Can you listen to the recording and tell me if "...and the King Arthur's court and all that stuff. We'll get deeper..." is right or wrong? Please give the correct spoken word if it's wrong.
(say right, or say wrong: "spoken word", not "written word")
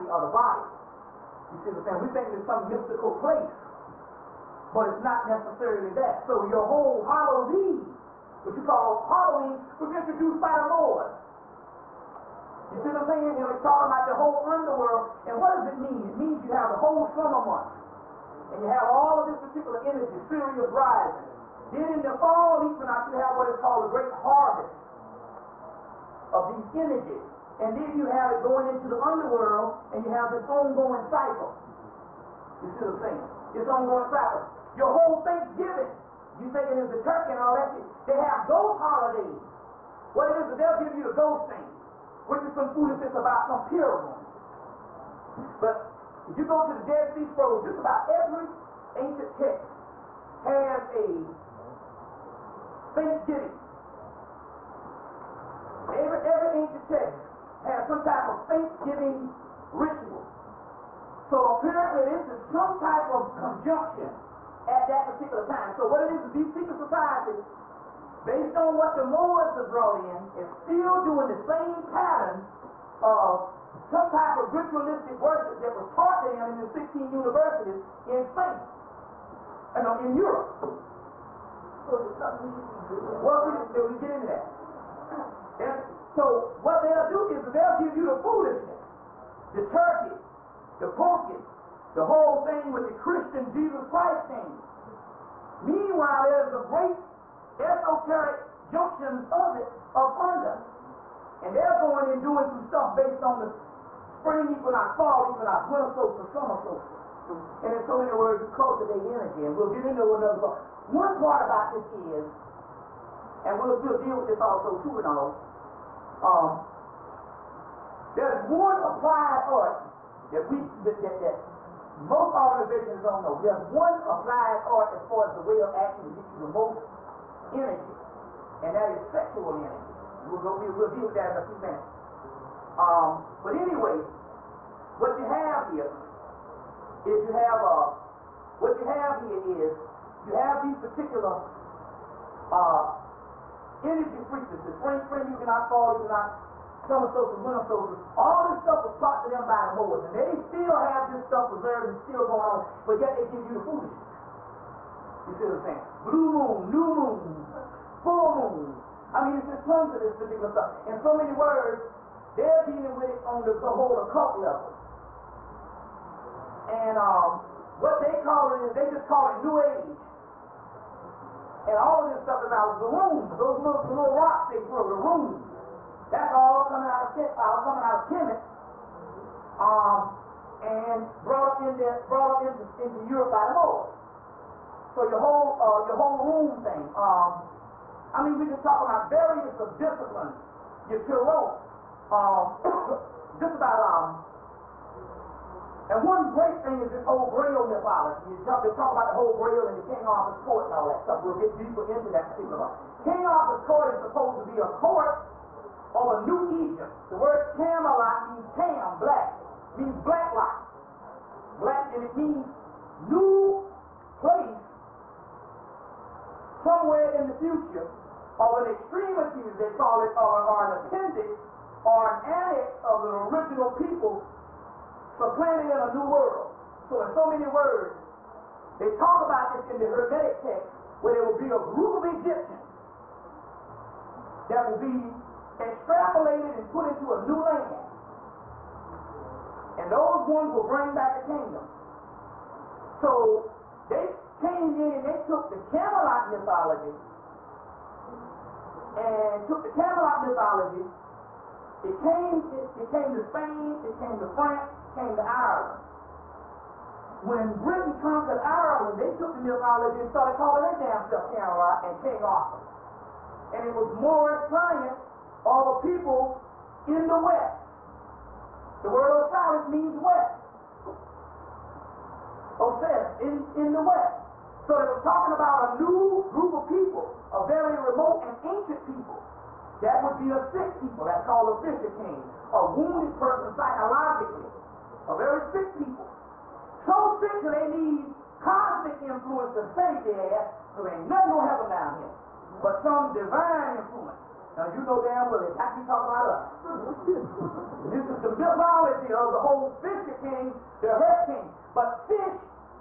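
right.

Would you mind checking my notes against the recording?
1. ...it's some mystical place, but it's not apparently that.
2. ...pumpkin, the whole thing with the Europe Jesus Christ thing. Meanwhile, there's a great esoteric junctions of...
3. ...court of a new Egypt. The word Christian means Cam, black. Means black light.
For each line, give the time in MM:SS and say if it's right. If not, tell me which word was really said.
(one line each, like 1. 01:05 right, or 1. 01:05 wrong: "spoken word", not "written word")
1. 00:02 wrong: "necessarily", not "apparently"
2. 01:30 wrong: "Christian", not "Europe"
3. 03:24 wrong: "Camelot", not "Christian".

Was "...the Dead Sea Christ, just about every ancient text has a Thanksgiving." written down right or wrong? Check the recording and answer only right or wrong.
wrong.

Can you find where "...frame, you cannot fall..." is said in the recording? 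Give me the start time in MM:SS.
02:25.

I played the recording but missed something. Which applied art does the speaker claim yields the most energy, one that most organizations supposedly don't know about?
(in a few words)
Sexual energy.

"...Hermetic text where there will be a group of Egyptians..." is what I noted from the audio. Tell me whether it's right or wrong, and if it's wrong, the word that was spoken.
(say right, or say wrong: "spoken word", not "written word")
right.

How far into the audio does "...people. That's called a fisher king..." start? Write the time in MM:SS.
04:40.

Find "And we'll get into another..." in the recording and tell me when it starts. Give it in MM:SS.
01:49.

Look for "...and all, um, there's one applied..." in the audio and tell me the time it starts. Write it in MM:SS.
01:54.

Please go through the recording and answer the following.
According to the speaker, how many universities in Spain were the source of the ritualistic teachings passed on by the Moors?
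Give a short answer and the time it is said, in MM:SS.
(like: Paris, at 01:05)
16, at 01:16.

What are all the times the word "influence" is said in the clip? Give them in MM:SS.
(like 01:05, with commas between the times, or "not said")
04:49, 04:53.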